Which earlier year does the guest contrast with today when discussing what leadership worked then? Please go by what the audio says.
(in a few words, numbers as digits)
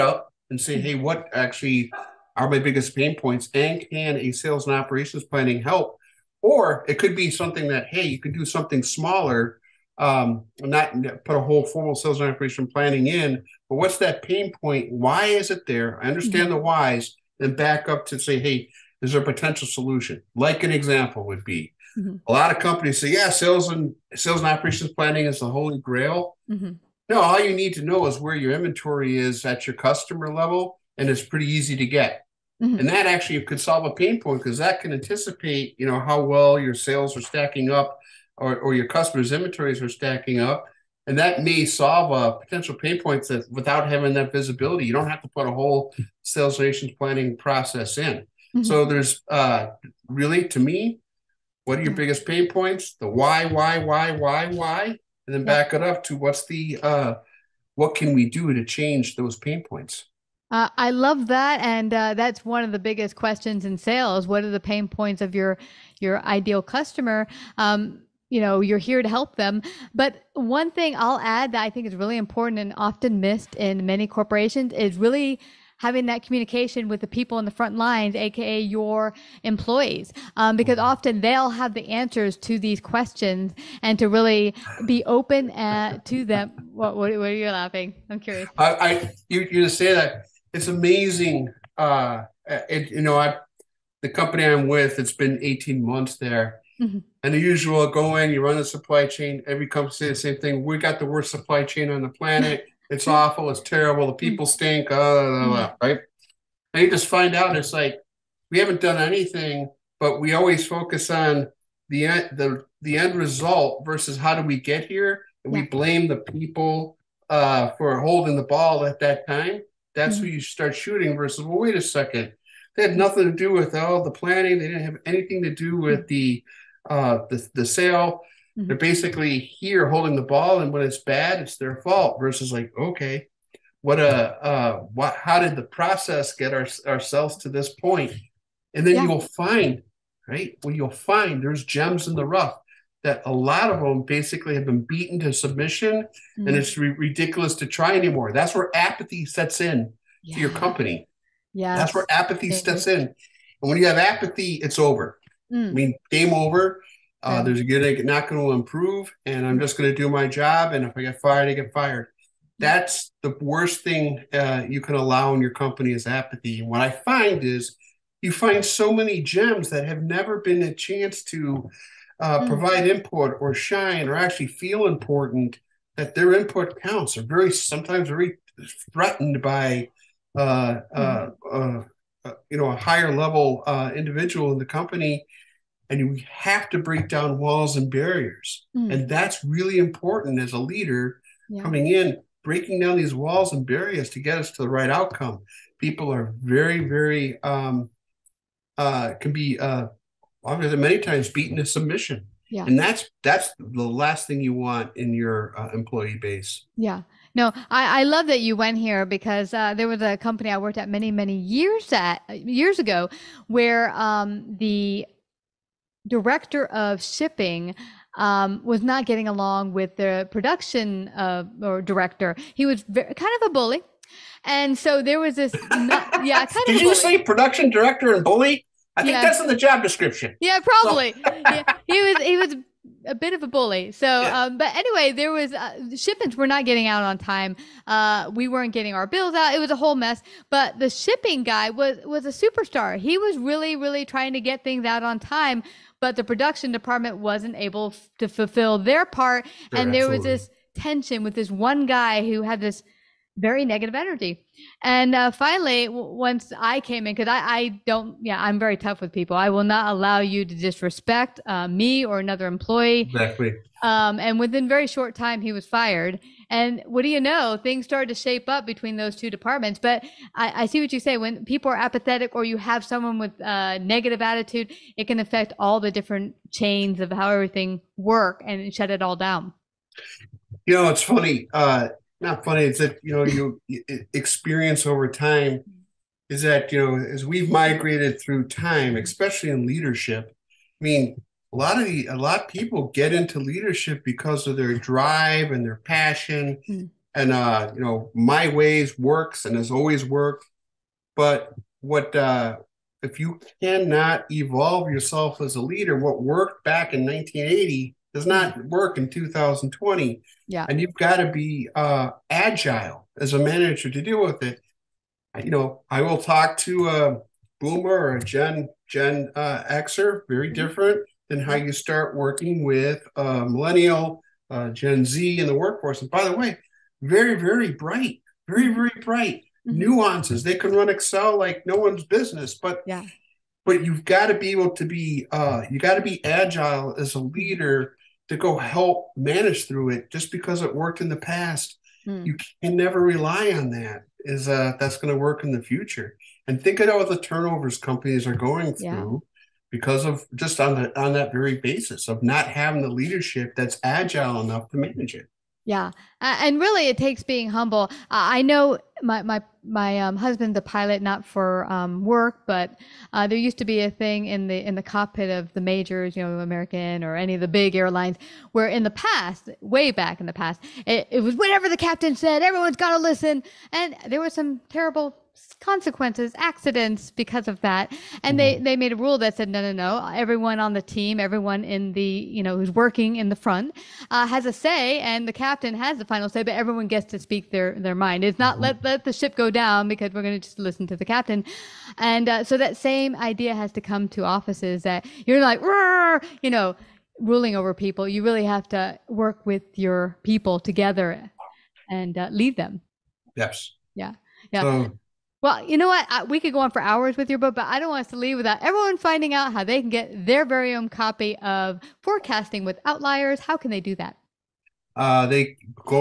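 1980.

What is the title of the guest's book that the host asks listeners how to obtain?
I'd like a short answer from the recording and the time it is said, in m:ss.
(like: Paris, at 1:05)
Forecasting with Out-liars, at 6:52.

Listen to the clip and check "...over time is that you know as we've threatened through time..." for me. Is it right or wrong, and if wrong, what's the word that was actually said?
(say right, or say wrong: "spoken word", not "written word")
wrong: "migrated", not "threatened".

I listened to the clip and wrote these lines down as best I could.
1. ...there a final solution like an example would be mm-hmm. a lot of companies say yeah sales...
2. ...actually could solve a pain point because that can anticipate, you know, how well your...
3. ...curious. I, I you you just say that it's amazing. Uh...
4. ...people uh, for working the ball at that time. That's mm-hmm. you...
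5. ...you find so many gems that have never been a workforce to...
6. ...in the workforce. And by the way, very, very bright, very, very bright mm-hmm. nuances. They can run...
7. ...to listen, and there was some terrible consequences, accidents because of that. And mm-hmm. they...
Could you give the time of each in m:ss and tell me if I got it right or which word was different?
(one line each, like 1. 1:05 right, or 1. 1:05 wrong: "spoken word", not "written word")
1. 0:19 wrong: "potential", not "final"
2. 0:33 right
3. 1:28 right
4. 1:56 wrong: "holding", not "working"
5. 2:48 wrong: "chance", not "workforce"
6. 5:25 right
7. 6:12 right.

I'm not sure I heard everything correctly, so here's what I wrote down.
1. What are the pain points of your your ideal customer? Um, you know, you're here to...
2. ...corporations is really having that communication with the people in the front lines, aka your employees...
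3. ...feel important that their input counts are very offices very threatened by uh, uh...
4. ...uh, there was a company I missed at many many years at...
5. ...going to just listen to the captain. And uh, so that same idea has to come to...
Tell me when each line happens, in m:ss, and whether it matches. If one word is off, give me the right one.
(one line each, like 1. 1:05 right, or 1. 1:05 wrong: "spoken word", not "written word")
1. 1:04 right
2. 1:14 right
3. 2:54 wrong: "sometimes", not "offices"
4. 3:29 wrong: "worked", not "missed"
5. 6:30 right.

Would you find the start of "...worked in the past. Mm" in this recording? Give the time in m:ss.
5:40.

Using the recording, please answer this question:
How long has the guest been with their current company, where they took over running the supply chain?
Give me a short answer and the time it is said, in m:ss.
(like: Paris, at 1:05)
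18 months, at 1:35.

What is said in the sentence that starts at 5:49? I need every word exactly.
because of just on the on that very basis of not having the leadership that's agile enough to manage it.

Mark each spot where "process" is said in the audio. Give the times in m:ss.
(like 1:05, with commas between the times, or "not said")
0:47, 2:15.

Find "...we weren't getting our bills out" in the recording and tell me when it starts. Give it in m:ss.
3:58.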